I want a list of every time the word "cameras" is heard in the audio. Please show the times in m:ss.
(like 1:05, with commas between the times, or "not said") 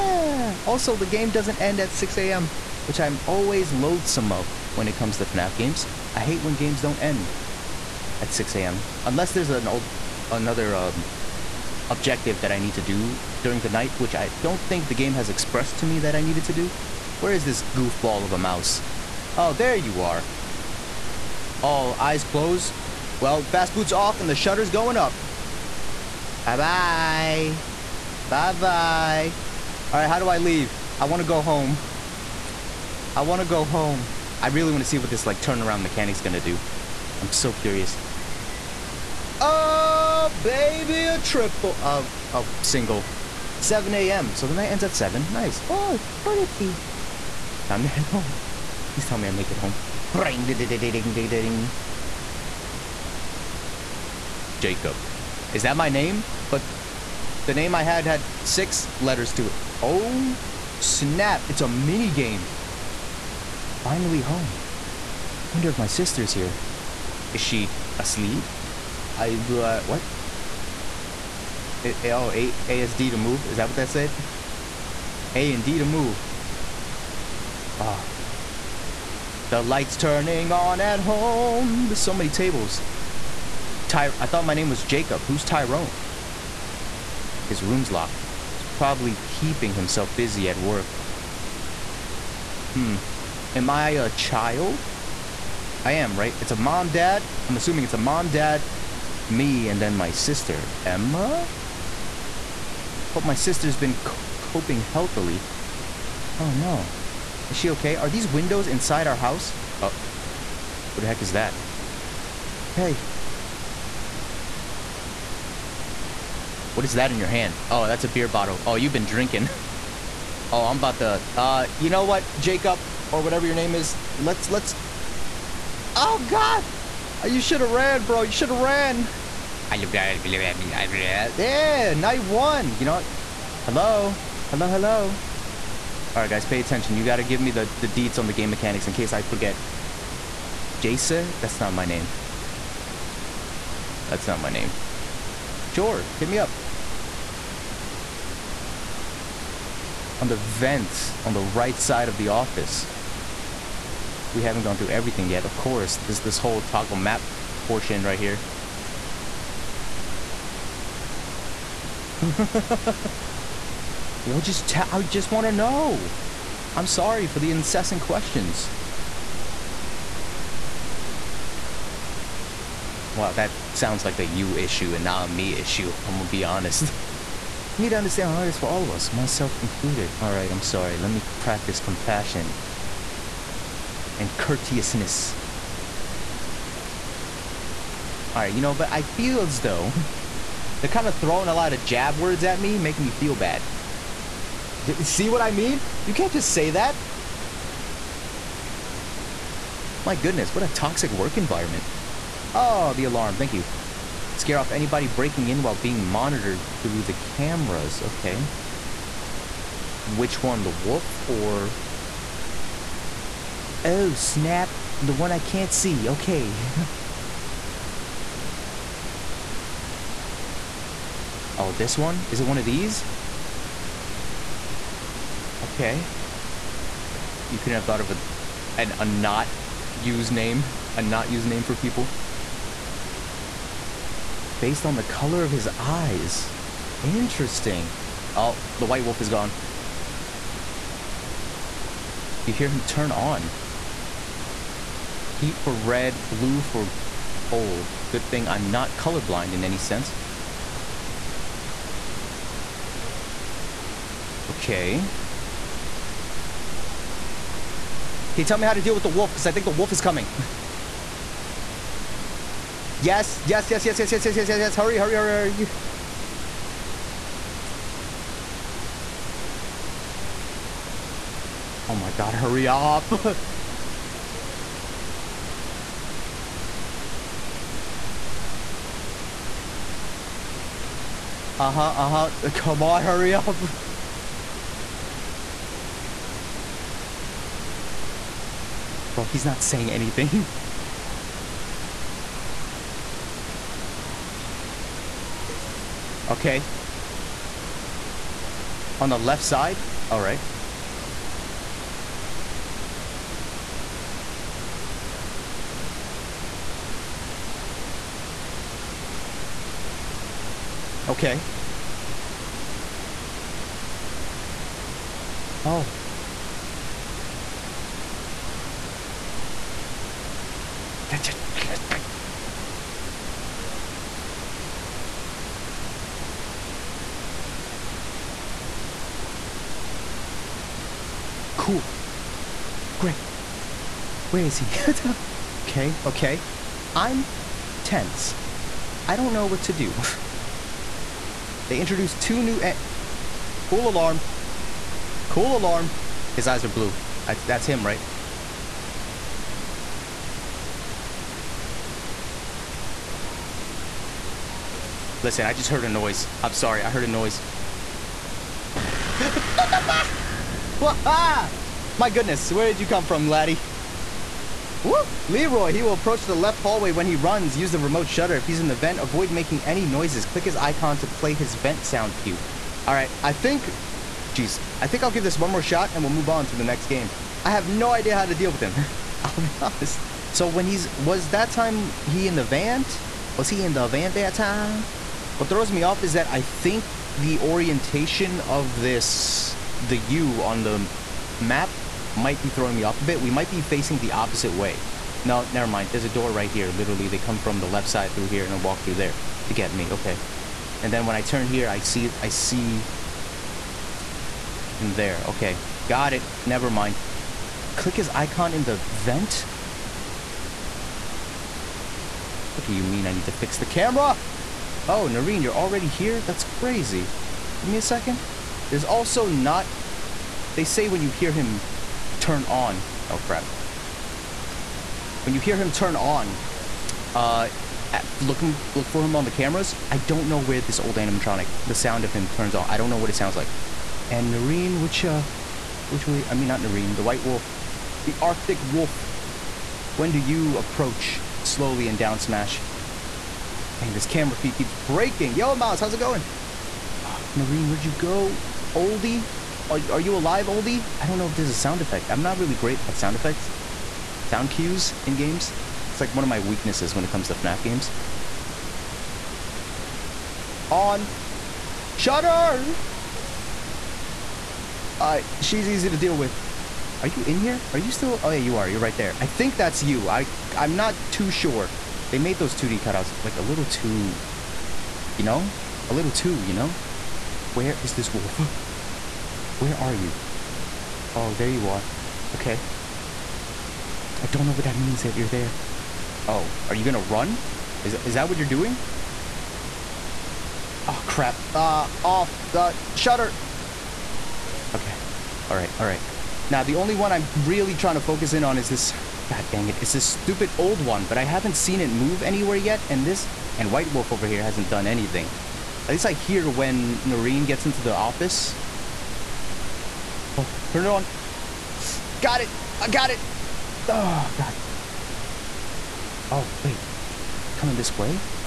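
3:27, 6:53, 7:09, 7:24.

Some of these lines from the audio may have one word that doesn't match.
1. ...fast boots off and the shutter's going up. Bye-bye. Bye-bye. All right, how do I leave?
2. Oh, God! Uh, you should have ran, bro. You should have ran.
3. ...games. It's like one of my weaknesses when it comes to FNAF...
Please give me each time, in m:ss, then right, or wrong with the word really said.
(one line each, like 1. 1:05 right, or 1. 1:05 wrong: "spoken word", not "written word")
1. 0:23 right
2. 2:05 right
3. 7:35 right.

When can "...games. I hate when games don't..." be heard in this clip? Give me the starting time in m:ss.
0:05.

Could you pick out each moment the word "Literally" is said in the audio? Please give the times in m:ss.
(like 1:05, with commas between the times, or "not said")
6:36.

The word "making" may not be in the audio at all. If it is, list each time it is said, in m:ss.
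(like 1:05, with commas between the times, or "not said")
3:12, 6:09.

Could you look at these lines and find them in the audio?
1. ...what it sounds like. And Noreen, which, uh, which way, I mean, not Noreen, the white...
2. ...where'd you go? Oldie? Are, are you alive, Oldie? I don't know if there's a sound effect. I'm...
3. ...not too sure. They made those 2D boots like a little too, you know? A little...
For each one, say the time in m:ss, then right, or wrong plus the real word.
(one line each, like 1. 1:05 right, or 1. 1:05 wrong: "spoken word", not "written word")
1. 7:12 right
2. 7:27 right
3. 7:50 wrong: "cutouts", not "boots".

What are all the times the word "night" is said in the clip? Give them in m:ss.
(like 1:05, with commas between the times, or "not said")
0:13, 0:44, 2:11.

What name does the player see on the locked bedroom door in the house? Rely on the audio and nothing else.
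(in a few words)
Tyrone.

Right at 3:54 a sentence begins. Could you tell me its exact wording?
Based on the color of his eyes.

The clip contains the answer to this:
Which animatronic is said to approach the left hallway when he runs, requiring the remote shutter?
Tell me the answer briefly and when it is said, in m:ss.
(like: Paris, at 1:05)
Leroy, at 6:05.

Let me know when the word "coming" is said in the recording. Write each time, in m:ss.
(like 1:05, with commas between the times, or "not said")
4:19, 8:37.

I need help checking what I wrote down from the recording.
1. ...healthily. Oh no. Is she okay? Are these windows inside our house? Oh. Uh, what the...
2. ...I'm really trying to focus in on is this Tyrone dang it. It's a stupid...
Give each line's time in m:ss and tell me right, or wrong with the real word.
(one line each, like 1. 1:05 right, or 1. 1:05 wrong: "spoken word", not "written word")
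1. 1:44 right
2. 8:17 wrong: "God", not "Tyrone".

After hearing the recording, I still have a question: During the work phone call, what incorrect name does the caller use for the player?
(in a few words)
Jace.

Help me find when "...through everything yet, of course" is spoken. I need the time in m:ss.
2:34.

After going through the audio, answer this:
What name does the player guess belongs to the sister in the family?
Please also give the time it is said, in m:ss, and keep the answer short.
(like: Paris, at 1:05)
Emma, at 1:40.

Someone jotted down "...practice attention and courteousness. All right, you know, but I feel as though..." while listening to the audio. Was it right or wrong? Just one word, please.
wrong.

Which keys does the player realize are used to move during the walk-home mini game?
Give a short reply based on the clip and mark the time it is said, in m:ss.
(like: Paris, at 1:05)
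A and D, at 1:15.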